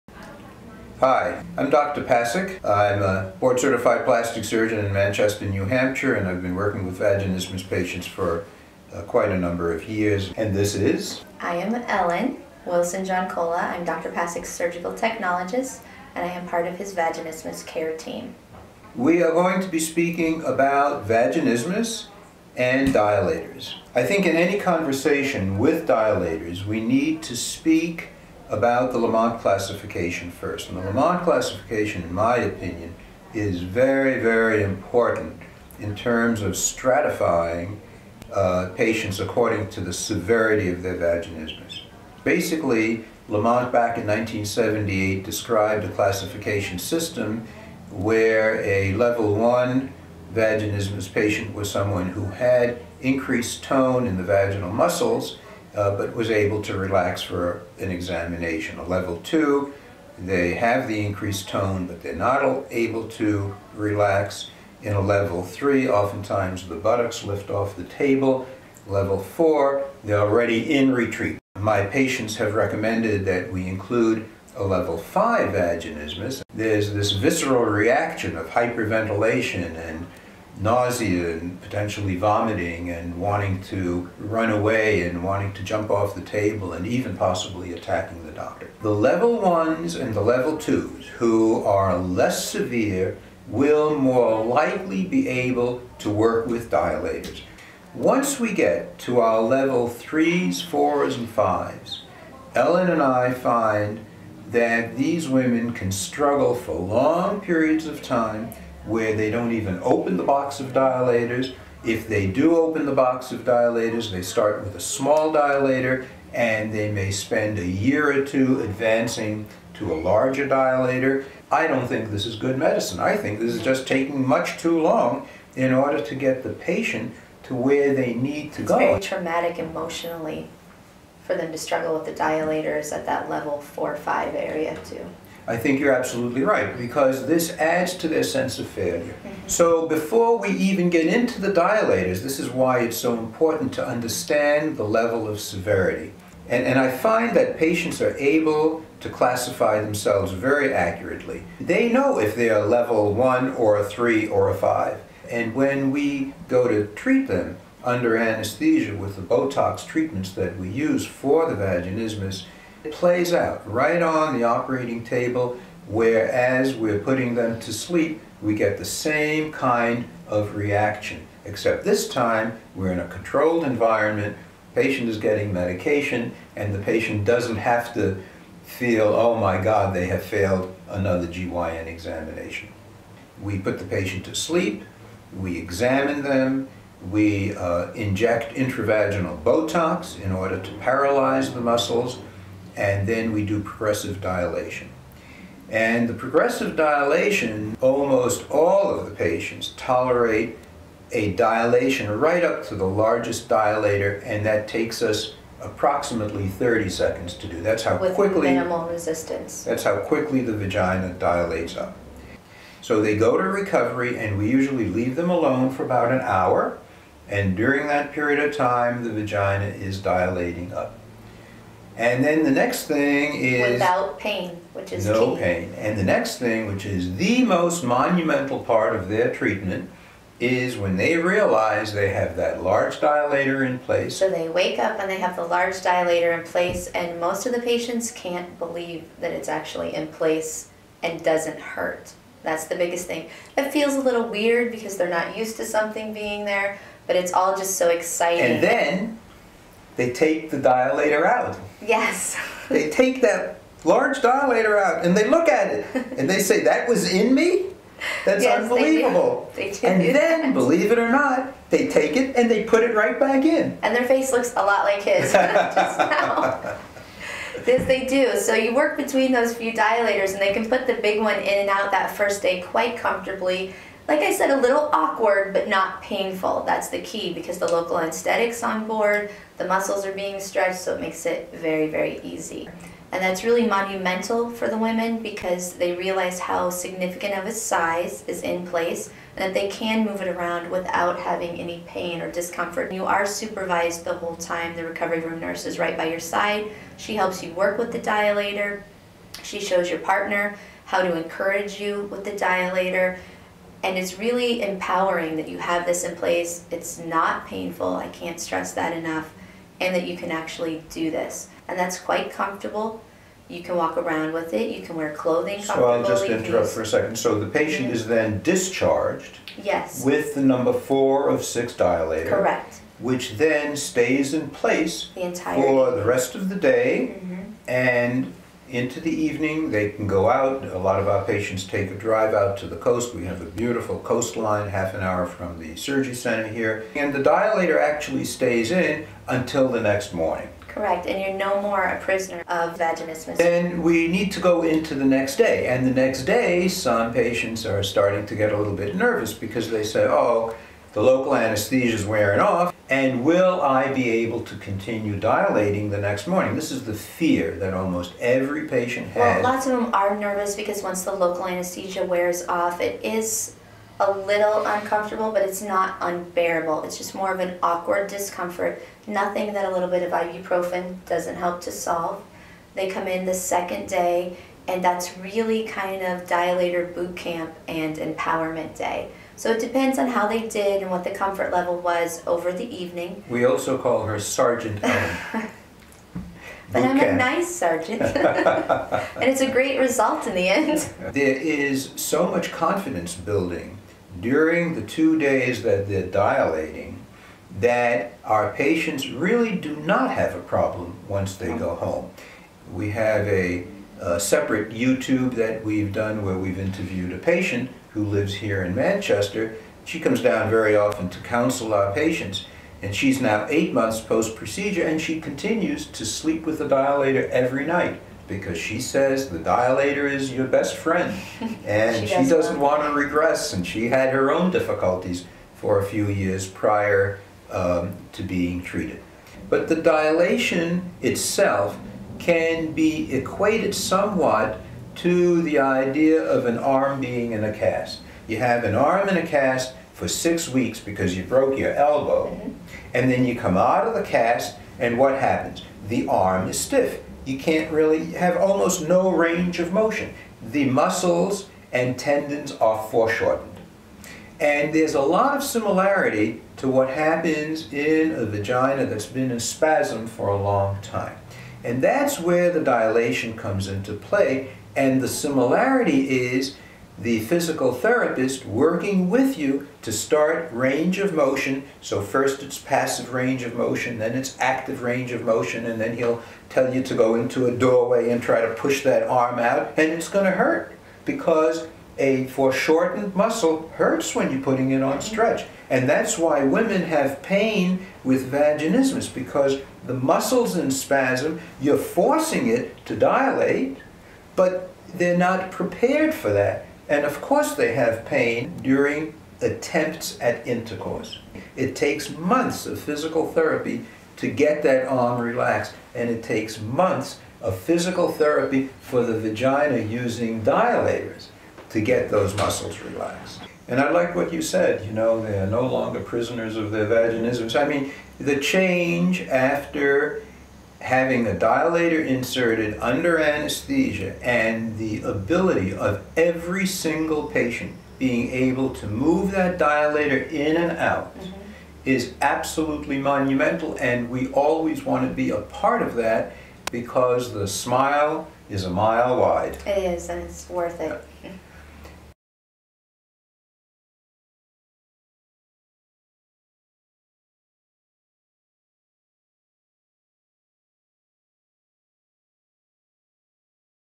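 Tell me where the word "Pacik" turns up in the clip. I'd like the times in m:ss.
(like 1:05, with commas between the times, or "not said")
0:02, 0:14.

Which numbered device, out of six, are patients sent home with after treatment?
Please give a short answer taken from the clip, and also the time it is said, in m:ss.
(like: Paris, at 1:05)
number 4, at 5:20.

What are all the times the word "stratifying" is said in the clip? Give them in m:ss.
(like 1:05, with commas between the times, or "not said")
0:36.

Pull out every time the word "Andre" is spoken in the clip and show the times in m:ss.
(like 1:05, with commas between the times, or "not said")
not said.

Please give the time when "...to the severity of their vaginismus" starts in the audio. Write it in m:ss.
0:39.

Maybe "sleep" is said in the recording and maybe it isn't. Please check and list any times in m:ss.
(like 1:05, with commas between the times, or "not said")
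2:47, 3:04, 6:56.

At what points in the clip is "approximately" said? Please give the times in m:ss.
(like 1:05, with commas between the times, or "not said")
3:25.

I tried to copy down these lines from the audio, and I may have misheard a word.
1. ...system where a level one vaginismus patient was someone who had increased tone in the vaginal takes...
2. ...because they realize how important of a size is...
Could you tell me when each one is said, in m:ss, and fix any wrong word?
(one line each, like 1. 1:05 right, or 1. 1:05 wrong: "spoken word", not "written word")
1. 0:46 wrong: "muscles", not "takes"
2. 4:45 wrong: "significant", not "important".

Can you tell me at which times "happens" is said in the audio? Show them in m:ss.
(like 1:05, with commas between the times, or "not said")
7:25, 7:36.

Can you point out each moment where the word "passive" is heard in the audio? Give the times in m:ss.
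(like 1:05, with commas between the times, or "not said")
7:52.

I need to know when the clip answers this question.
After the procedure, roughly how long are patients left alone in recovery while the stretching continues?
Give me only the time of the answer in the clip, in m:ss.
3:35.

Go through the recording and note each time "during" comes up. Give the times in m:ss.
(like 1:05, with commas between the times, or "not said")
3:37, 6:34, 8:18.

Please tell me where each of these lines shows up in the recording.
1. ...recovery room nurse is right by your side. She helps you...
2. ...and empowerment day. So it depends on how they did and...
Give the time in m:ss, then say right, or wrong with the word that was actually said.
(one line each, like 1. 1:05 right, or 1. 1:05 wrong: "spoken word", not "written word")
1. 4:54 right
2. 6:17 right.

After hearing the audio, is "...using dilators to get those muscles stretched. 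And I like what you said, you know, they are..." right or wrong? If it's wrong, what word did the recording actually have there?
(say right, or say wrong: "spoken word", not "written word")
wrong: "relaxed", not "stretched".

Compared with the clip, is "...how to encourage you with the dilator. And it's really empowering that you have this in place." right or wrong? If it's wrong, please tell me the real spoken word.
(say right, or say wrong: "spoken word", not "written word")
right.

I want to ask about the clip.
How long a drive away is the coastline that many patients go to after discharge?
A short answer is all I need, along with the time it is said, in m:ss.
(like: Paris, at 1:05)
half an hour, at 5:34.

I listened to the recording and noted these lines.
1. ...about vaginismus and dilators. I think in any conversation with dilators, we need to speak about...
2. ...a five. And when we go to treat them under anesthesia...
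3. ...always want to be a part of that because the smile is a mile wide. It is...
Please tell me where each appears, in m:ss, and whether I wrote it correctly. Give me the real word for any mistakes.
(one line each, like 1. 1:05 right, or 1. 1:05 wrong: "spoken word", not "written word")
1. 0:20 right
2. 2:34 right
3. 8:54 right.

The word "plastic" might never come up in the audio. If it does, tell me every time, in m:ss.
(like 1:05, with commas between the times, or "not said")
0:04.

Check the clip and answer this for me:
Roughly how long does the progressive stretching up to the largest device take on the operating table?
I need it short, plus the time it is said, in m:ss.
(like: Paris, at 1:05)
30 seconds, at 3:26.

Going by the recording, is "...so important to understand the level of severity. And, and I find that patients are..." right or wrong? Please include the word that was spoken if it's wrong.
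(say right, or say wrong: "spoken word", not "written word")
right.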